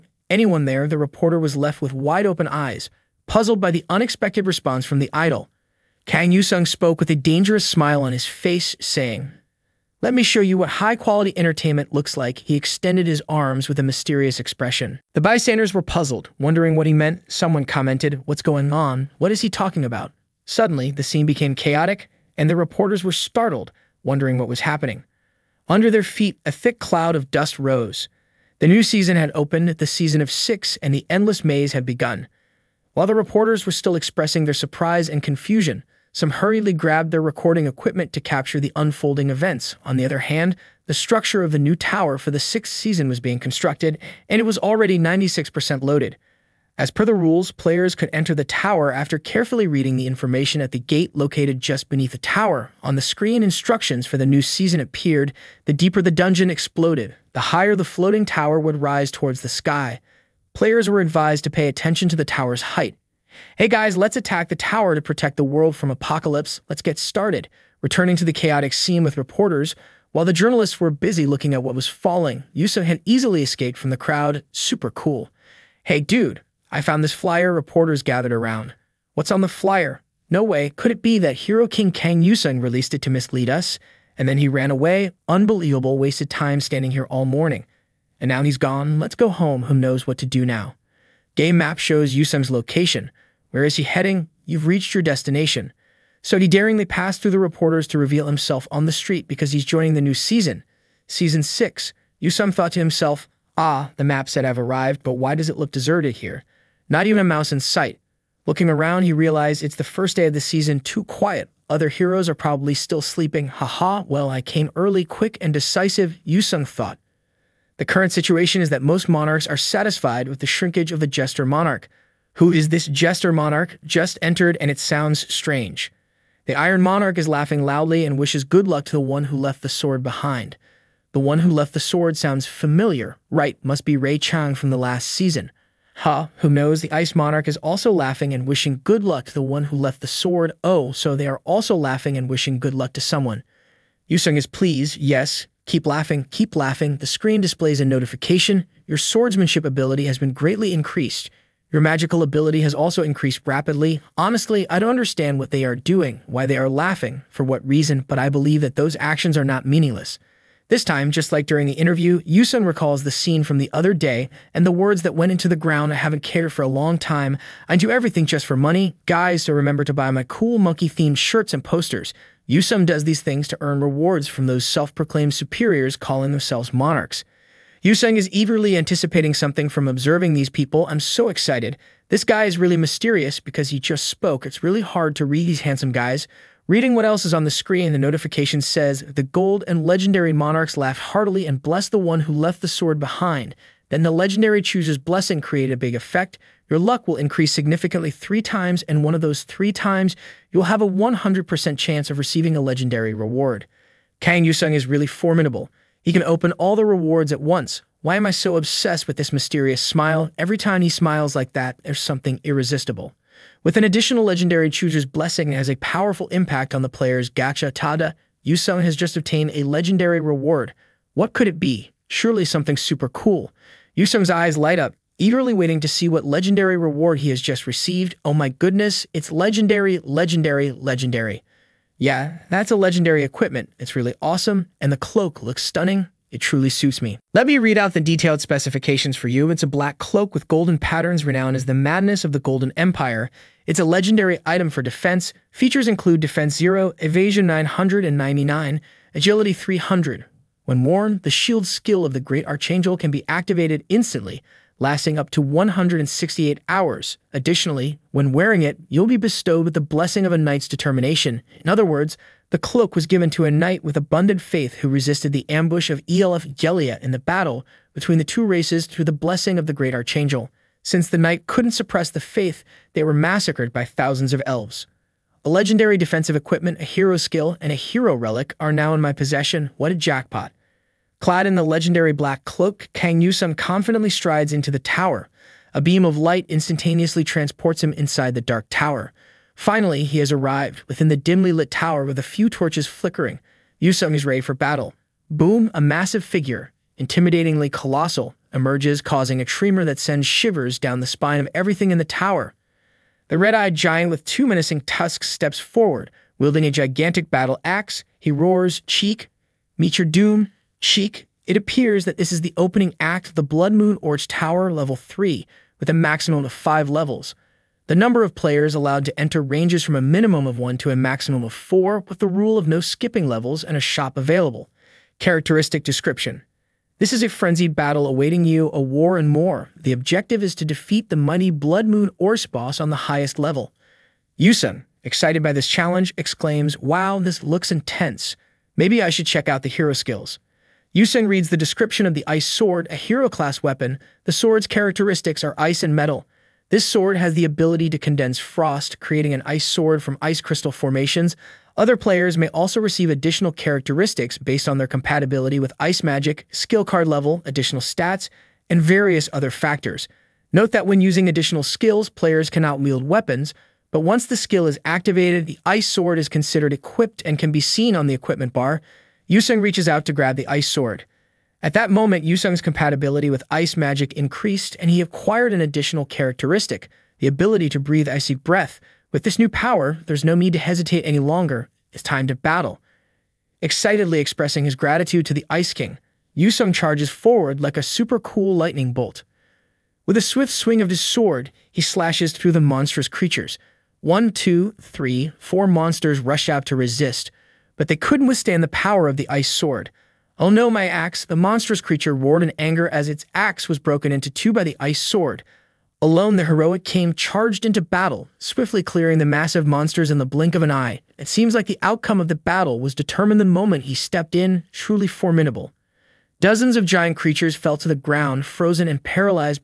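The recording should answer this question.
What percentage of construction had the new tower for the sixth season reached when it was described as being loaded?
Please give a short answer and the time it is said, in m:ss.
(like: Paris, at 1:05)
96%, at 0:44.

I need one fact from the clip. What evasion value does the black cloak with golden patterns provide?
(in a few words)
999.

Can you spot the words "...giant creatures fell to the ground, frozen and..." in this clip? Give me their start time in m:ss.
6:56.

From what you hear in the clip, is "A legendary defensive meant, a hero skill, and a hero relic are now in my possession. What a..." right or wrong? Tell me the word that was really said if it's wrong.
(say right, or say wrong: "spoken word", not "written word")
wrong: "equipment", not "meant".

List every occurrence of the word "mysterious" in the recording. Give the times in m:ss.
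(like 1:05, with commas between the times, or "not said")
0:13, 3:02, 3:29.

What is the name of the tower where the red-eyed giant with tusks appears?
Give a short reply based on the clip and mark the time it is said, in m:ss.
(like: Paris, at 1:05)
Blood Moon Orc Tower, at 5:13.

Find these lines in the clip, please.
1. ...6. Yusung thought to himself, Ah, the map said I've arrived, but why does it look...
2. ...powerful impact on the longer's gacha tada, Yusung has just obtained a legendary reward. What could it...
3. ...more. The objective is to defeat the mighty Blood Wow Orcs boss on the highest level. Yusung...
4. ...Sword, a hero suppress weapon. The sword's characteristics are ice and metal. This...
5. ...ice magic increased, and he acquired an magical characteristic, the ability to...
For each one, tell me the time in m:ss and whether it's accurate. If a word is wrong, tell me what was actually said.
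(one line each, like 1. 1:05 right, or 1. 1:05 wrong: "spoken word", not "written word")
1. 1:41 right
2. 3:35 wrong: "player", not "longer"
3. 5:29 wrong: "Moon", not "Wow"
4. 5:42 wrong: "class", not "suppress"
5. 6:13 wrong: "additional", not "magical".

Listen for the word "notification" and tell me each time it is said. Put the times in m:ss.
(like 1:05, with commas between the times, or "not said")
2:27, 3:07.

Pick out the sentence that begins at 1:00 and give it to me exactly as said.
Players were advised to pay attention to the tower's height.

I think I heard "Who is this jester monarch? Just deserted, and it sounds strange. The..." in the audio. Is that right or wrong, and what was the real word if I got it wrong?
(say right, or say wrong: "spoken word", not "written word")
wrong: "entered", not "deserted".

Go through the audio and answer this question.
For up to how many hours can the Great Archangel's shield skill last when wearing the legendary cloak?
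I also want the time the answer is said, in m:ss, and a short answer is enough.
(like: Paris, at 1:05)
168, at 4:15.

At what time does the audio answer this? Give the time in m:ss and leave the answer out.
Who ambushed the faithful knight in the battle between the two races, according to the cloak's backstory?
4:26.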